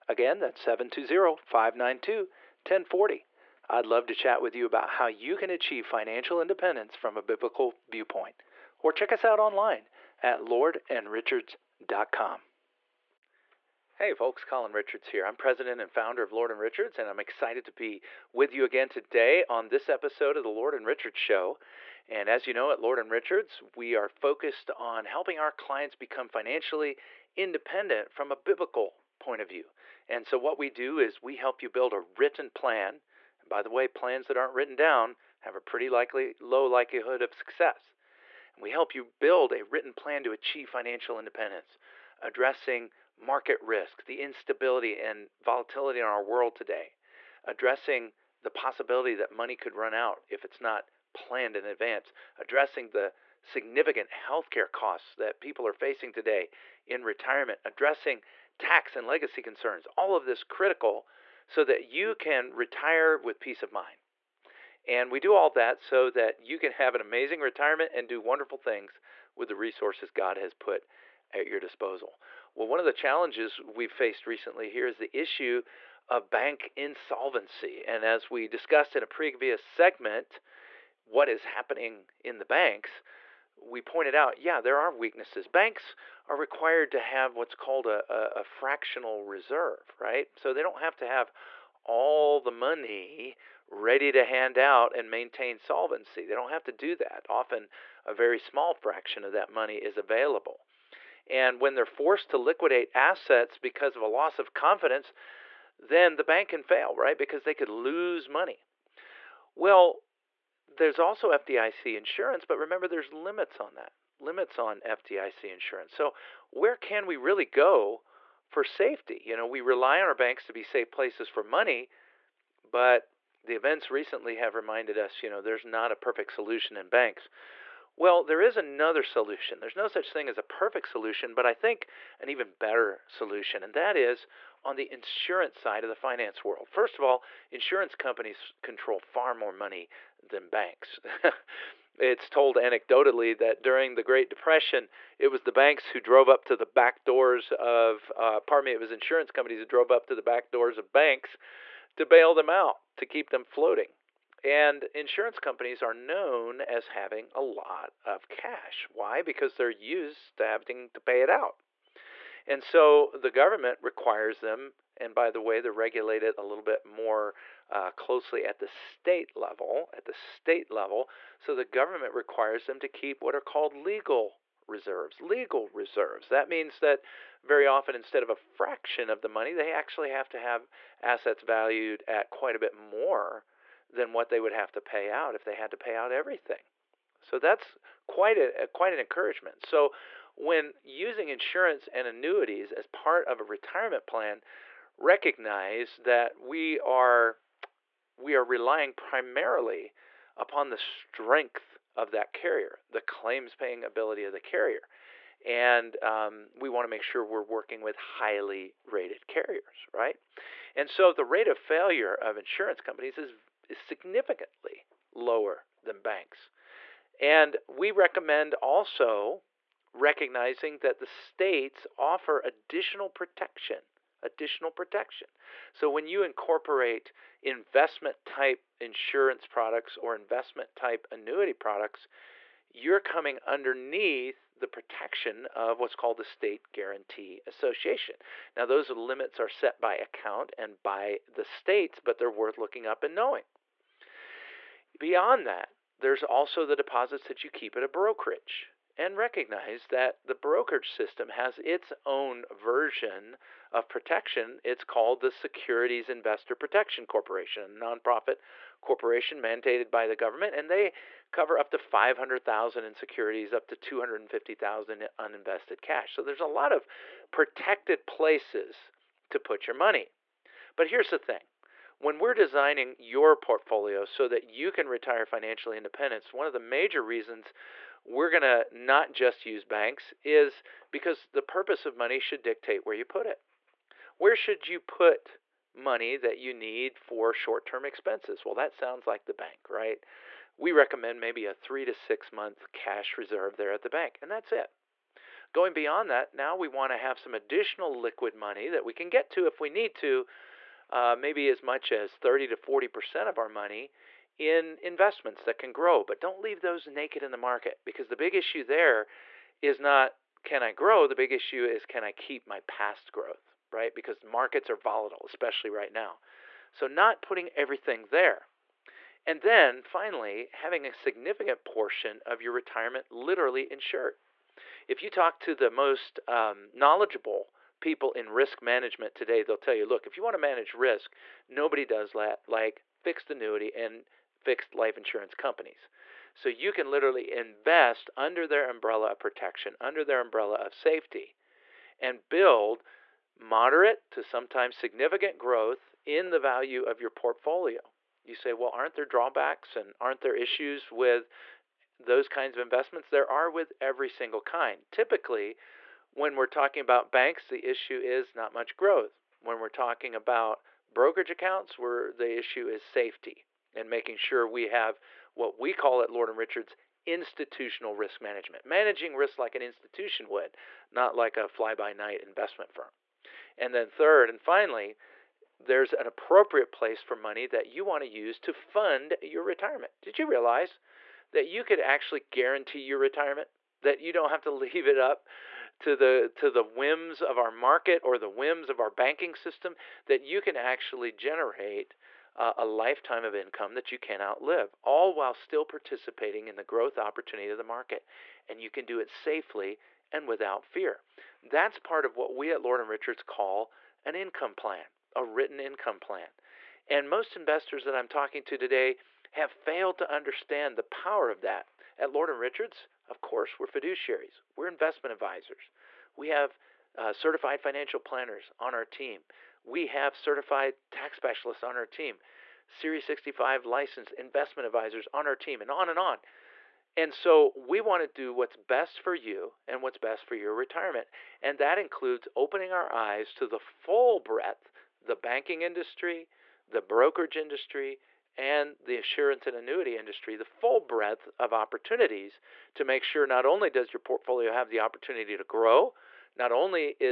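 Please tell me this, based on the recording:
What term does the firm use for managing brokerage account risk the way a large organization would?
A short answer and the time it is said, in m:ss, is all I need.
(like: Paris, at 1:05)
Institutional risk management, at 6:07.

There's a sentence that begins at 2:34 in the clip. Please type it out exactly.
And insurance companies are known as having a lot of cash.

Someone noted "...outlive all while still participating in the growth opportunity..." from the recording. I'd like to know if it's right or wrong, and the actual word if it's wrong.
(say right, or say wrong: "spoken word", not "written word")
right.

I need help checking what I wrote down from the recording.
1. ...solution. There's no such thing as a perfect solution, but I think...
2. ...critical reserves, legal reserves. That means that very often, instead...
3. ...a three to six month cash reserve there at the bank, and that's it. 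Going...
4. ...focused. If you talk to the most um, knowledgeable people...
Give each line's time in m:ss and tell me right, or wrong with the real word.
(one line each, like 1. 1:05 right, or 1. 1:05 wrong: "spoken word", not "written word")
1. 2:09 right
2. 2:53 wrong: "legal", not "critical"
3. 4:51 right
4. 5:23 wrong: "insured", not "focused".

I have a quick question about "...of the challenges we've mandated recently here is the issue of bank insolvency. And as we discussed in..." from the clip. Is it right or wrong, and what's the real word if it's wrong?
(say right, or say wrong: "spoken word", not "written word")
wrong: "faced", not "mandated".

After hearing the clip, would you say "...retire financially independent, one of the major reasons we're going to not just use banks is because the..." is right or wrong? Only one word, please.
right.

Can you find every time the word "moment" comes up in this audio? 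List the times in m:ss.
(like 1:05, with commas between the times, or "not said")
not said.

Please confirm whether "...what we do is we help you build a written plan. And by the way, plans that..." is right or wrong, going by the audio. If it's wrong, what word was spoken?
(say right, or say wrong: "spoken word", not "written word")
right.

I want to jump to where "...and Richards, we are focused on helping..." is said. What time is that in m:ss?
0:22.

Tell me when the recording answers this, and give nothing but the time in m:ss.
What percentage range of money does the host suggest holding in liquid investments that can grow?
5:02.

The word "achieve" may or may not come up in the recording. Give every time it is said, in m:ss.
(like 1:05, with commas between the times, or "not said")
0:05, 0:40.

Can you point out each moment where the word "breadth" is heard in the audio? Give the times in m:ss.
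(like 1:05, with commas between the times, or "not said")
7:14, 7:20.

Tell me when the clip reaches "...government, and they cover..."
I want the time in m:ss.
4:20.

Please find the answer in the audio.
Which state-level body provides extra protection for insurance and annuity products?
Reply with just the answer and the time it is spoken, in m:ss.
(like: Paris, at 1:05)
State Guarantee Association, at 3:56.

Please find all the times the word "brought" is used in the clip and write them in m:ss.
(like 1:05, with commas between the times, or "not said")
not said.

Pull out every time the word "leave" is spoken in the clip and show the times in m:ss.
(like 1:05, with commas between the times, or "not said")
5:06, 6:24.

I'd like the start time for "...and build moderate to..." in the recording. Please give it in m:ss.
5:41.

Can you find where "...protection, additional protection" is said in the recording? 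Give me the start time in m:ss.
3:43.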